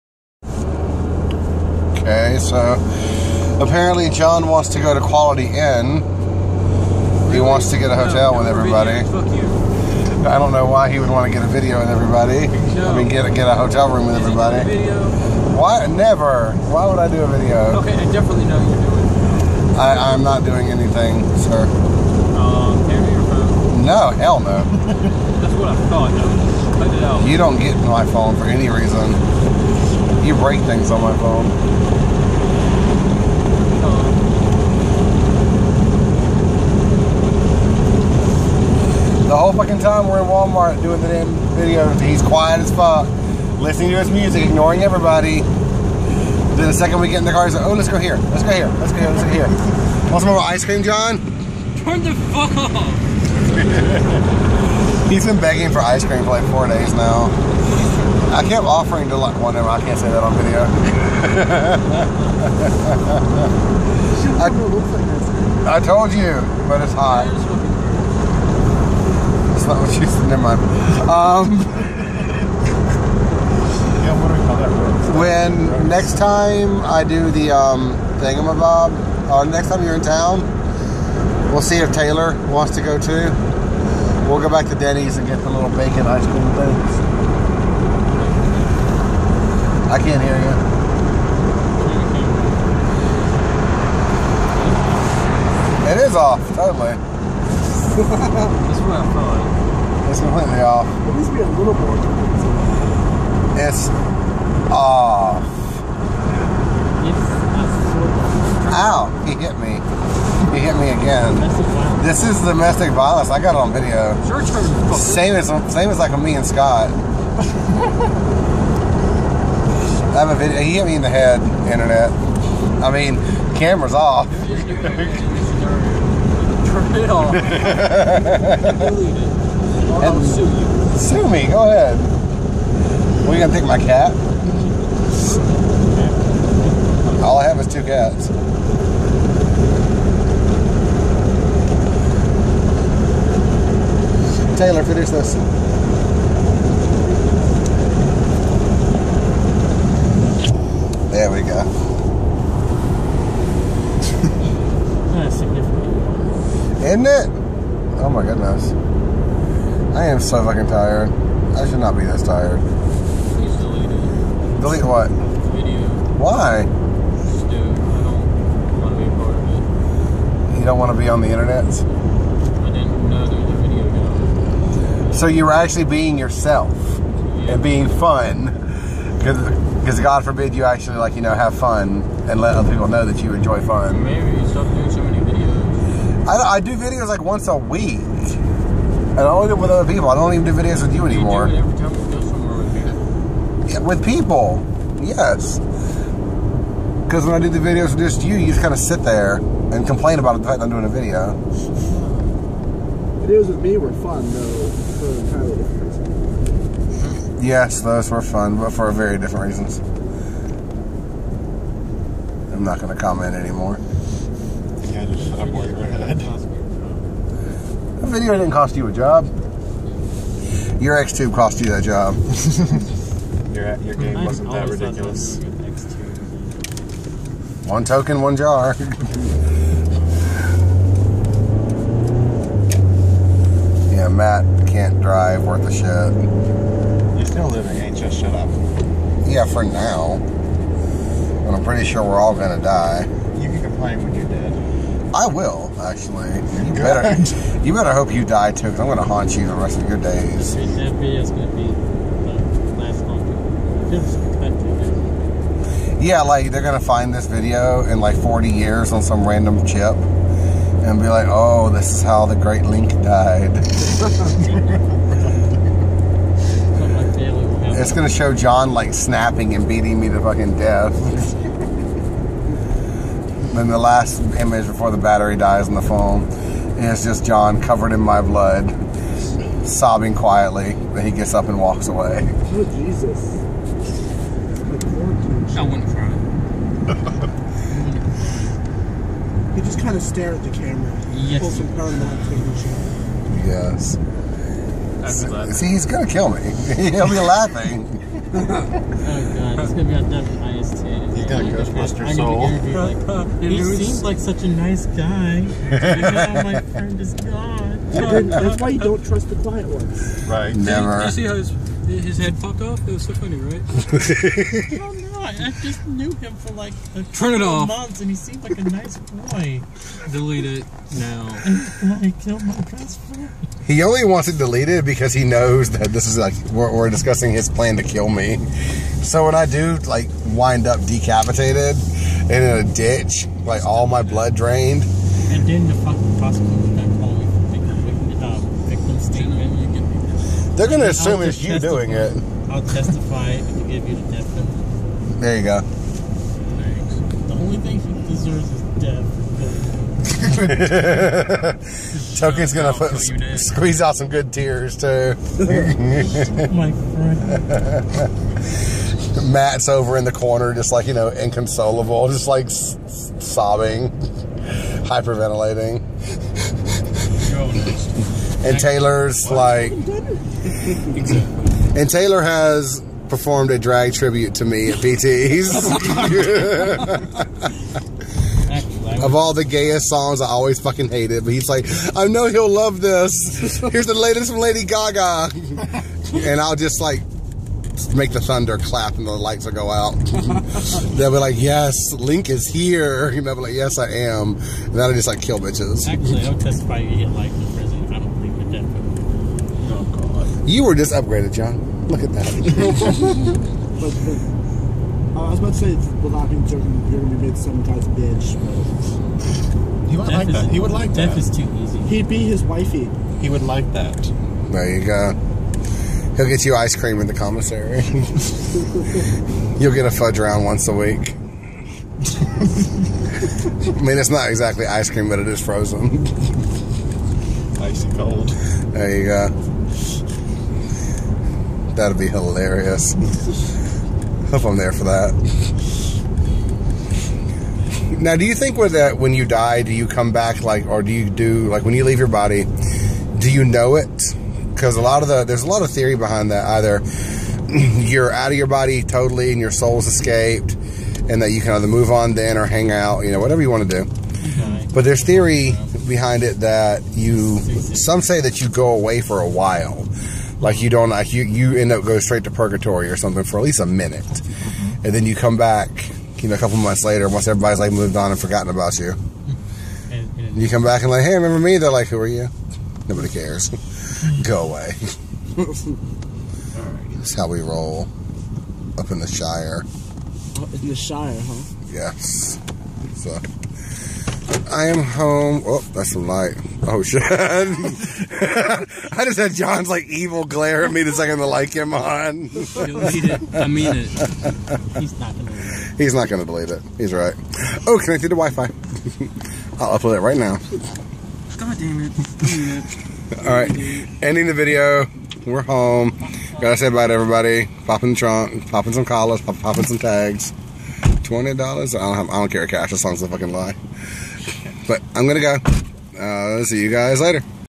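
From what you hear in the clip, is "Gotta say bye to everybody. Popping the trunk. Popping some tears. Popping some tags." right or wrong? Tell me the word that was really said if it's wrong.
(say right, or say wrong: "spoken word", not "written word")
wrong: "collars", not "tears".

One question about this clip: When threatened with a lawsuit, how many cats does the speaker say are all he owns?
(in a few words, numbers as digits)
2.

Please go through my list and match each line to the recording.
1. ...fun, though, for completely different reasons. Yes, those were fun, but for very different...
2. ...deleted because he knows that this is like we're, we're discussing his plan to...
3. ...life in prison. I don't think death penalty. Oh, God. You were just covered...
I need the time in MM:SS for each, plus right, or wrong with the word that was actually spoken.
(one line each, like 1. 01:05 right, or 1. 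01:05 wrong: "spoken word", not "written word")
1. 03:23 wrong: "entirely", not "completely"
2. 05:24 right
3. 06:37 wrong: "upgraded", not "covered".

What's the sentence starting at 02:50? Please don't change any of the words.
You don't want to be on the internet?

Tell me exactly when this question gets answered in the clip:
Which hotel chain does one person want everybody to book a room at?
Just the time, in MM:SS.
00:04.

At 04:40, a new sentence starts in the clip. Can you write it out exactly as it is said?
Then he gets up and walks away.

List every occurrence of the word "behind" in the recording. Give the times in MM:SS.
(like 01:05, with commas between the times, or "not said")
07:25, 07:35.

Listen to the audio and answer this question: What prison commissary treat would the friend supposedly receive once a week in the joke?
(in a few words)
fudge round.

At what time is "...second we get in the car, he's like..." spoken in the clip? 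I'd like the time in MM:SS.
00:46.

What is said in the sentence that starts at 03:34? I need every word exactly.
Yeah, That video didn't cost you a job.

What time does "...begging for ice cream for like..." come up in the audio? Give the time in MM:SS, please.
00:55.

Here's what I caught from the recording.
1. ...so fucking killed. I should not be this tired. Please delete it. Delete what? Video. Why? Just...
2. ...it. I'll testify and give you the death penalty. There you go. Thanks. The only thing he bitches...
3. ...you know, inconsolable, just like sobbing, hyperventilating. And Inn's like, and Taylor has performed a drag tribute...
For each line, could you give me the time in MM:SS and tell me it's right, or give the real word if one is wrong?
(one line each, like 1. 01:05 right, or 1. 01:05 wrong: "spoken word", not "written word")
1. 02:40 wrong: "tired", not "killed"
2. 05:41 wrong: "deserves", not "bitches"
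3. 06:00 wrong: "Taylor", not "Inn".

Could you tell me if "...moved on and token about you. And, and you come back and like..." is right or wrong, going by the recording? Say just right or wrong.
wrong.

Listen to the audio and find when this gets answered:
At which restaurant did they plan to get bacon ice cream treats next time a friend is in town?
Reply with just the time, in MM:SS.
01:24.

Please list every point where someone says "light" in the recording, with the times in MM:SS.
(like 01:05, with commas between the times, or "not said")
06:29, 08:06, 08:11.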